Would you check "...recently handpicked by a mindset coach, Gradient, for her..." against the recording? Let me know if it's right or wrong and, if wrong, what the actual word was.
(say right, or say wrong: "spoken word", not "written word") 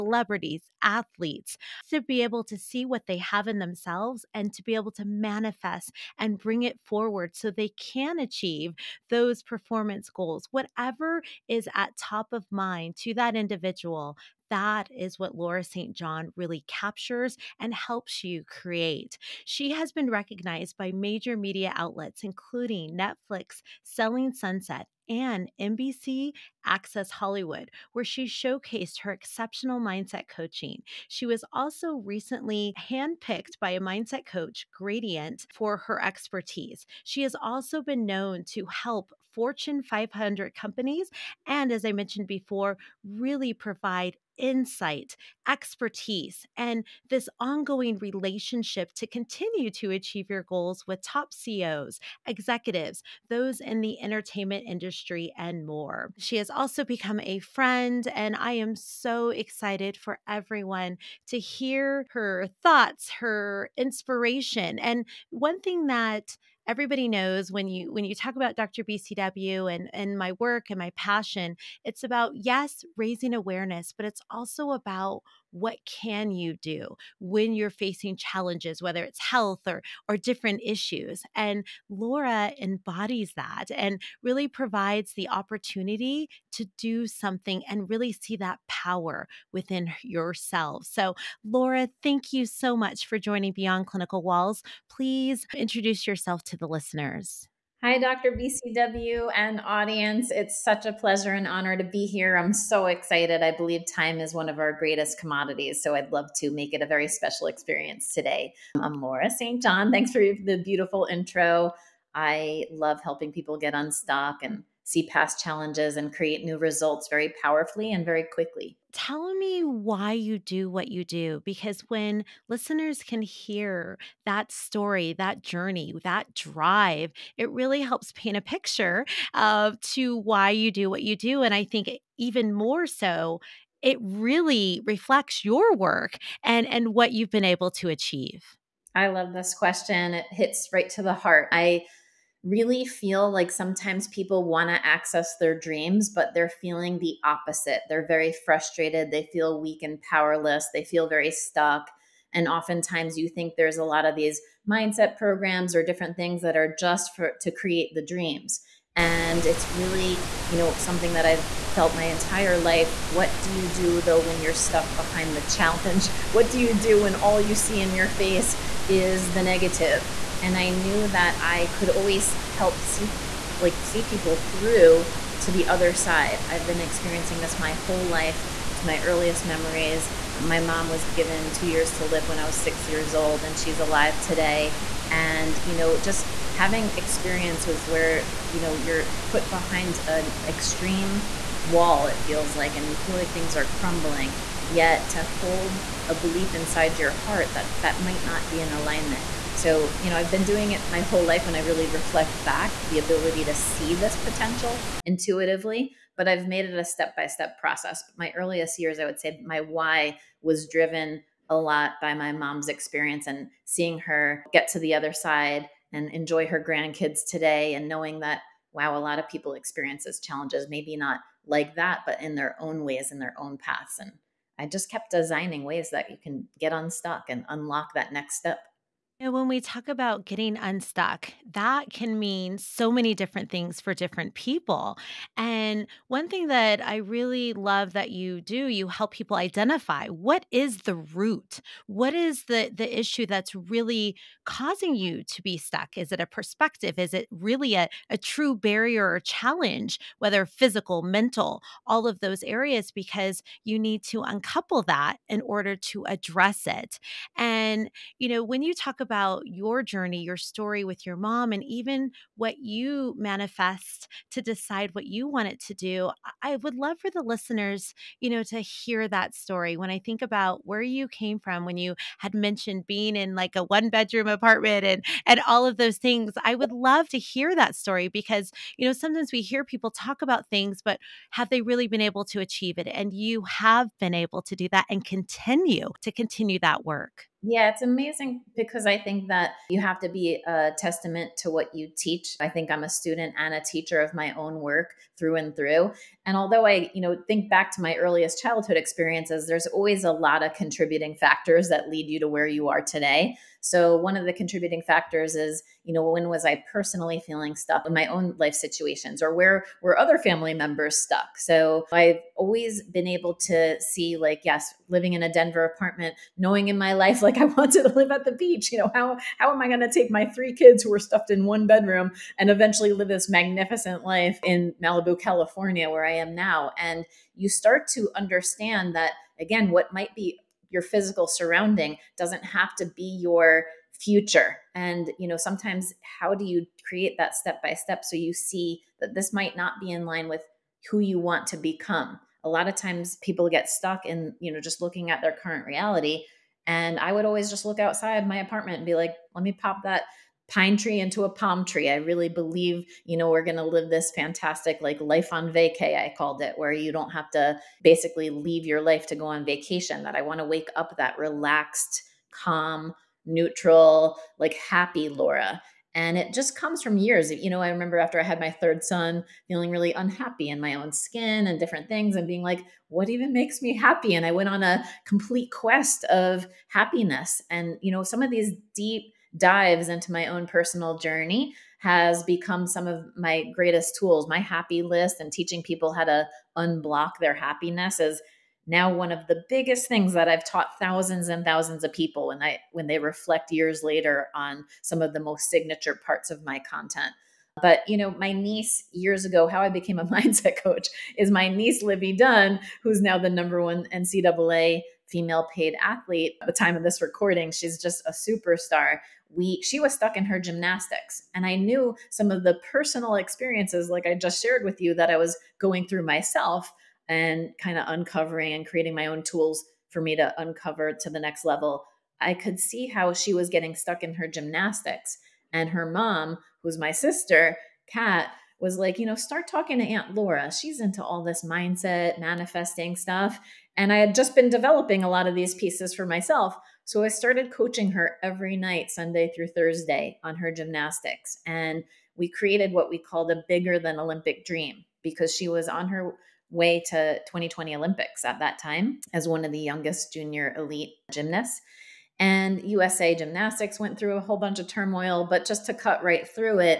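right.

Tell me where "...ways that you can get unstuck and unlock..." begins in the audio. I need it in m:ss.
3:45.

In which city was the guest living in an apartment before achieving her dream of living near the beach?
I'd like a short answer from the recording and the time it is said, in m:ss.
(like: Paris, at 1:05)
Denver, at 5:15.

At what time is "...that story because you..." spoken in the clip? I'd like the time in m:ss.
4:37.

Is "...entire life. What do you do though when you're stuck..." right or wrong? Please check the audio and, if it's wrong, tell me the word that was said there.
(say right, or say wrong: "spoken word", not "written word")
right.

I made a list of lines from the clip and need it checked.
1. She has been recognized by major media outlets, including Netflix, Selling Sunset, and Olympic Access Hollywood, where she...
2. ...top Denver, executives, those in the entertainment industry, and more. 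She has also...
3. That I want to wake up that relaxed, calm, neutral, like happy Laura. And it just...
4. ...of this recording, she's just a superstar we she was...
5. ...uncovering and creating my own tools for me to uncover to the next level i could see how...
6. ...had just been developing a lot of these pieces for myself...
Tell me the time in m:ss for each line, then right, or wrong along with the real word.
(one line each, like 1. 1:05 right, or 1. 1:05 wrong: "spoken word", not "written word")
1. 0:19 wrong: "NBC", not "Olympic"
2. 0:51 wrong: "CEOs", not "Denver"
3. 6:00 right
4. 6:46 right
5. 6:57 right
6. 7:13 right.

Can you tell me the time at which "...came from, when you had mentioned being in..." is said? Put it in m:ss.
4:31.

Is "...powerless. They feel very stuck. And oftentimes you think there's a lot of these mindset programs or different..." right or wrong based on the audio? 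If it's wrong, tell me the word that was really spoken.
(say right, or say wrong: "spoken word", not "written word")
right.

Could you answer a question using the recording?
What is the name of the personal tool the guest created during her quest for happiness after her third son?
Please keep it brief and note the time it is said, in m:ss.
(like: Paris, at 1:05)
Happy list, at 6:24.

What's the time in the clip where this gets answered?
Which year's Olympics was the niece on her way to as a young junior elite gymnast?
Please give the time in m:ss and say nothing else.
7:27.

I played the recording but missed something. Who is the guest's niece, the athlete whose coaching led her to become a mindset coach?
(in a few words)
Livvy Dunne.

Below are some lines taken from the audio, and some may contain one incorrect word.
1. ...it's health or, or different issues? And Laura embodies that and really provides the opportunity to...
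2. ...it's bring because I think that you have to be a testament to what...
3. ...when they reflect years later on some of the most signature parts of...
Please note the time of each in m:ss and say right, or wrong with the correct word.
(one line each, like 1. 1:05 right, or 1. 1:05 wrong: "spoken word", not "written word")
1. 1:19 right
2. 4:47 wrong: "amazing", not "bring"
3. 6:32 right.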